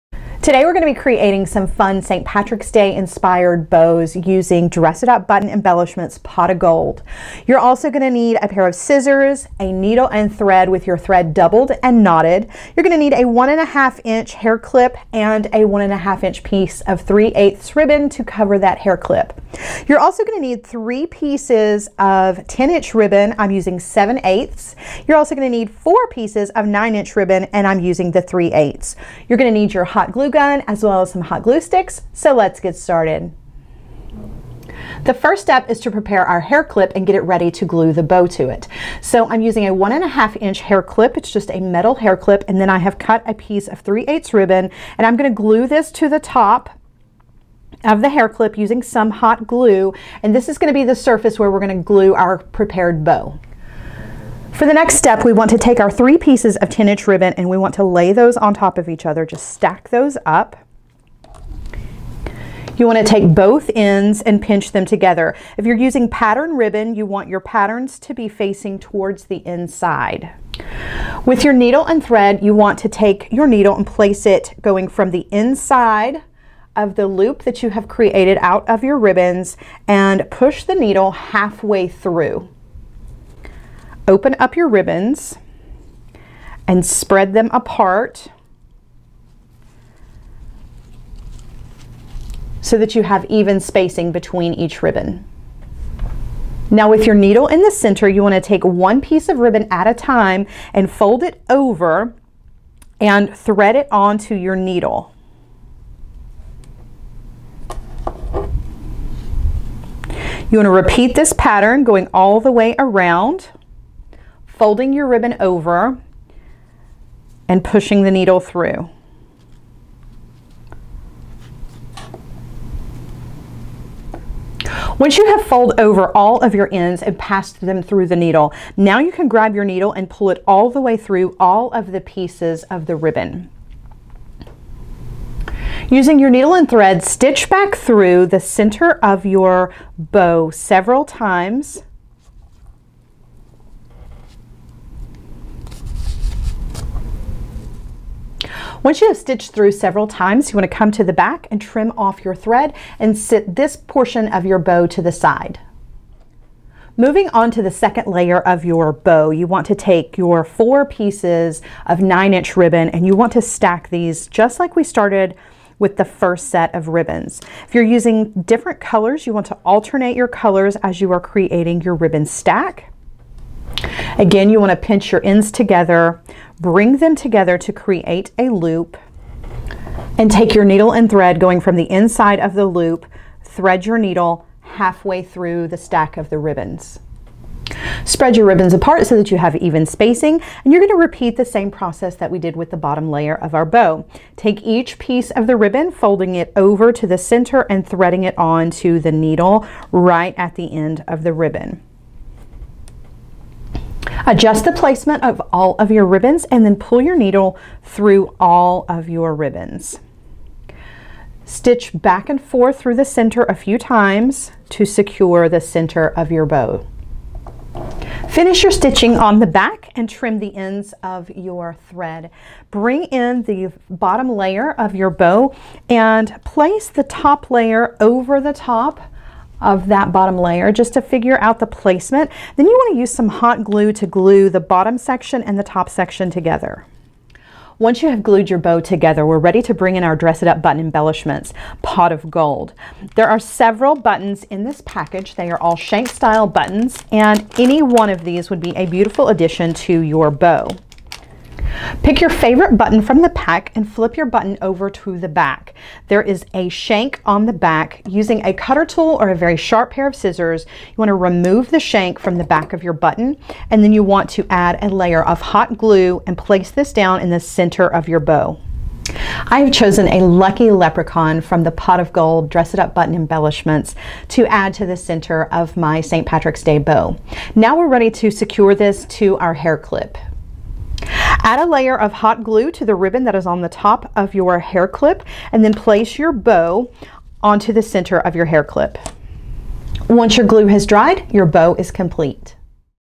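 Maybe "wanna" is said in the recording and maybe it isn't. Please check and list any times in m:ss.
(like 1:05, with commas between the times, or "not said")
1:38, 1:50, 2:30.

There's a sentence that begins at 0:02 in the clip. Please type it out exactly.
Patrick's Day inspired bows using Dress It Up Button Embellishments Pot of Gold.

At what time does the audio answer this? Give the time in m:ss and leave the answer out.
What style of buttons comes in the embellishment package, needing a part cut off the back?
4:05.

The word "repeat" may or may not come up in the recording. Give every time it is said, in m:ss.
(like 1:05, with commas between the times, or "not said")
1:50, 3:11.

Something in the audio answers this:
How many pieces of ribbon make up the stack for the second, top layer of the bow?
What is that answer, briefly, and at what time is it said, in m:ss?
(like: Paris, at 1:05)
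4, at 2:40.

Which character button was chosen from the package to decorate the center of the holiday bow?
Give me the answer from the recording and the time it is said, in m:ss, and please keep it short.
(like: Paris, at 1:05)
Lucky leprechaun, at 4:30.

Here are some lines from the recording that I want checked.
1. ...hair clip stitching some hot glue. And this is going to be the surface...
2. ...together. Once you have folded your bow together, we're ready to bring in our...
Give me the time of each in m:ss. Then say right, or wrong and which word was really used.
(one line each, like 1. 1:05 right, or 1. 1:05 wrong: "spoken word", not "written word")
1. 0:48 wrong: "using", not "stitching"
2. 3:56 wrong: "glued", not "folded".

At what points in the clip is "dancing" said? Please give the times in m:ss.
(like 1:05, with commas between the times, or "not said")
not said.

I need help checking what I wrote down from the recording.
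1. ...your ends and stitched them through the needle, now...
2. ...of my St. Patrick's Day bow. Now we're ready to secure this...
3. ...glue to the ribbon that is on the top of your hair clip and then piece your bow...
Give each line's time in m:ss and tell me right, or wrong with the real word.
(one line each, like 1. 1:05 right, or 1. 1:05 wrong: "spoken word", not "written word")
1. 2:06 wrong: "passed", not "stitched"
2. 4:35 right
3. 4:42 wrong: "place", not "piece".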